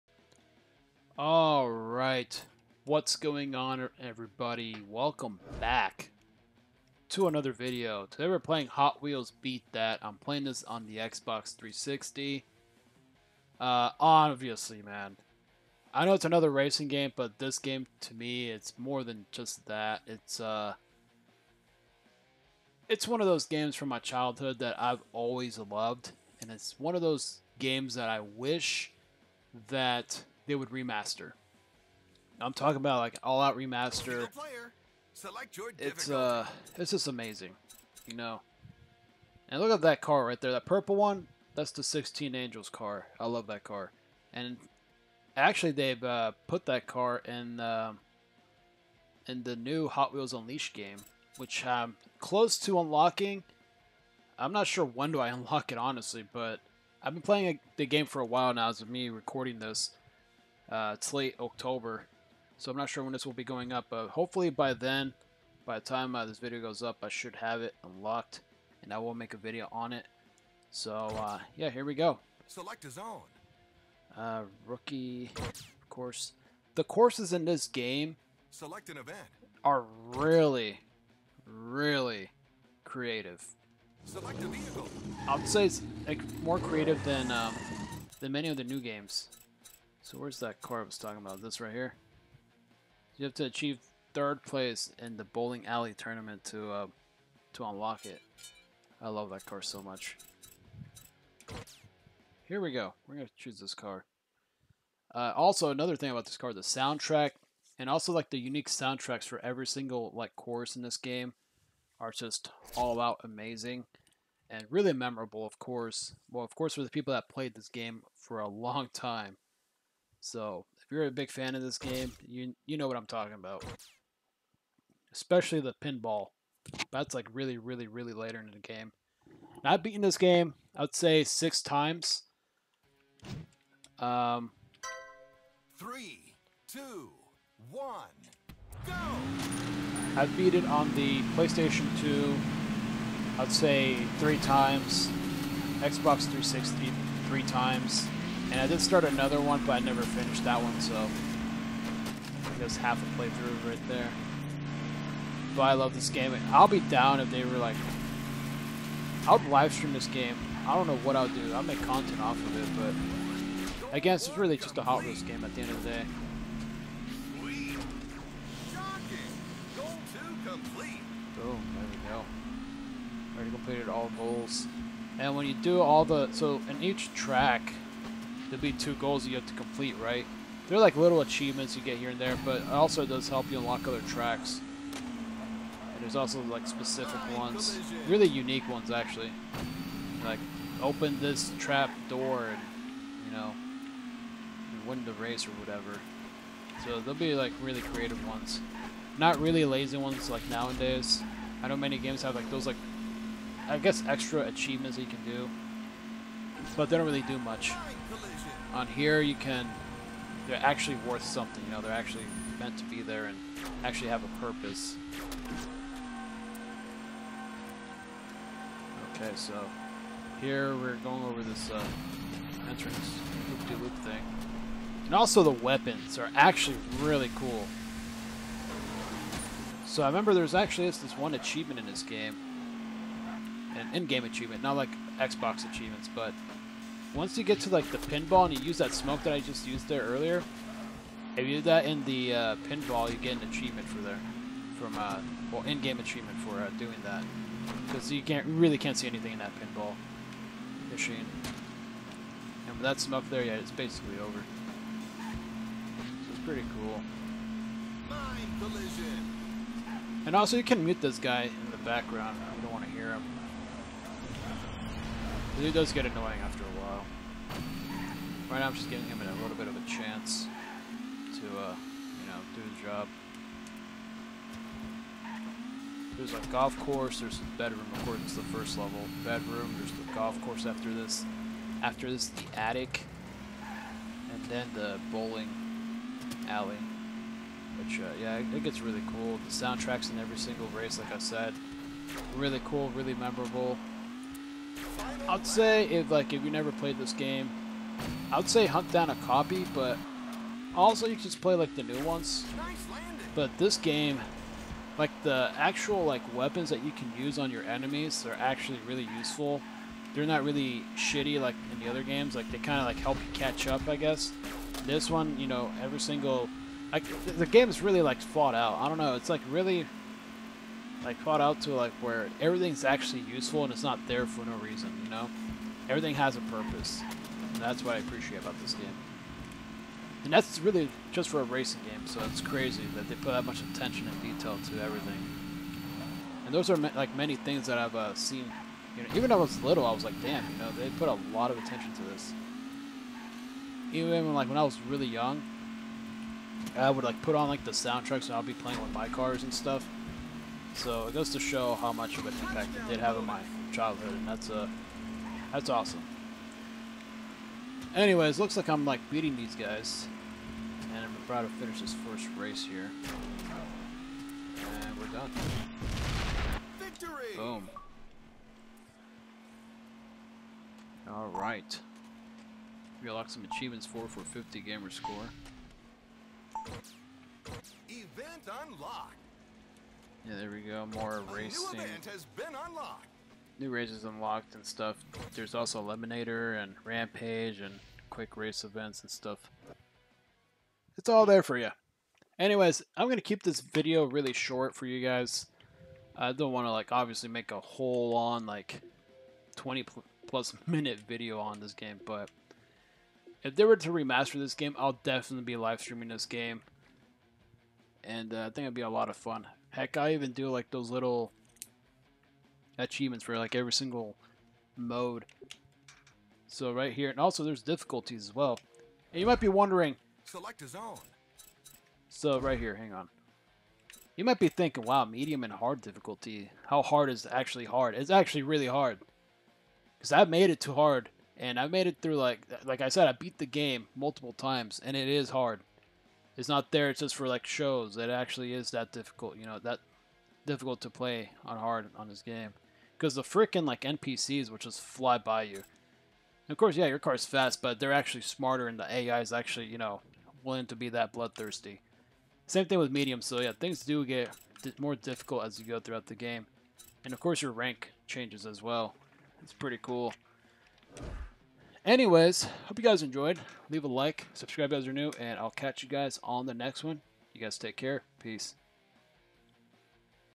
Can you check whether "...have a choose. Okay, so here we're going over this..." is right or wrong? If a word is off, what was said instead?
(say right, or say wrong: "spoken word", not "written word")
wrong: "purpose", not "choose".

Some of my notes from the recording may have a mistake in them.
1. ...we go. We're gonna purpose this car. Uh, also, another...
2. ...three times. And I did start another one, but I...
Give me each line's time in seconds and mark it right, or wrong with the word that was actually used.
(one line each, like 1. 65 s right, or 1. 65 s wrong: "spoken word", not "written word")
1. 102 s wrong: "choose", not "purpose"
2. 147 s right.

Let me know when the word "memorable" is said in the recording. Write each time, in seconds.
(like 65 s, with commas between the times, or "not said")
114 s, 293 s.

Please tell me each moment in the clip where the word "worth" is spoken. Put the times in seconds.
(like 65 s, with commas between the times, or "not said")
211 s.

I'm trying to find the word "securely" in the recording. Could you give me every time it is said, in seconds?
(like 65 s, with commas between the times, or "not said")
not said.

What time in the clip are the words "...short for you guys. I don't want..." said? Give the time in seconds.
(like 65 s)
394 s.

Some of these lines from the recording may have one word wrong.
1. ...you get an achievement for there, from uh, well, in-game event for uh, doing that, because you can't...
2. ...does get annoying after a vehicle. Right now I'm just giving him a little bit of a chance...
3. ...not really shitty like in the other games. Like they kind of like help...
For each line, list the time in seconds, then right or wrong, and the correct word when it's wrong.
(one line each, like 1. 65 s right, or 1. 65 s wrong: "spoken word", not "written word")
1. 243 s wrong: "achievement", not "event"
2. 265 s wrong: "while", not "vehicle"
3. 310 s right.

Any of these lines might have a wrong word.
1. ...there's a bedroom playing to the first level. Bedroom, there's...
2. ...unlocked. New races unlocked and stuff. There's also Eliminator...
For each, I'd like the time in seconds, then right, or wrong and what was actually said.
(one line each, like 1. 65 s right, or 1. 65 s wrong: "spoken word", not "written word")
1. 277 s wrong: "according", not "playing"
2. 382 s right.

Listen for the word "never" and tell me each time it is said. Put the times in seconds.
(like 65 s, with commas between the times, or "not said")
149 s, 296 s.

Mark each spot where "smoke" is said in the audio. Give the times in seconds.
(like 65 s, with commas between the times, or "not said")
238 s, 252 s.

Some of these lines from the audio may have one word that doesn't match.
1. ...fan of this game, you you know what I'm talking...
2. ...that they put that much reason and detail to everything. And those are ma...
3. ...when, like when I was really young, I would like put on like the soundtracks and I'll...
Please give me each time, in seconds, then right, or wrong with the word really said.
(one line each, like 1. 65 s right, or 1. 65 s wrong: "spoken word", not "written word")
1. 121 s right
2. 332 s wrong: "attention", not "reason"
3. 344 s right.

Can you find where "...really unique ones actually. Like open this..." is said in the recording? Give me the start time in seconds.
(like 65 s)
188 s.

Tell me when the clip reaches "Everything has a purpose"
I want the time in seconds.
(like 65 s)
325 s.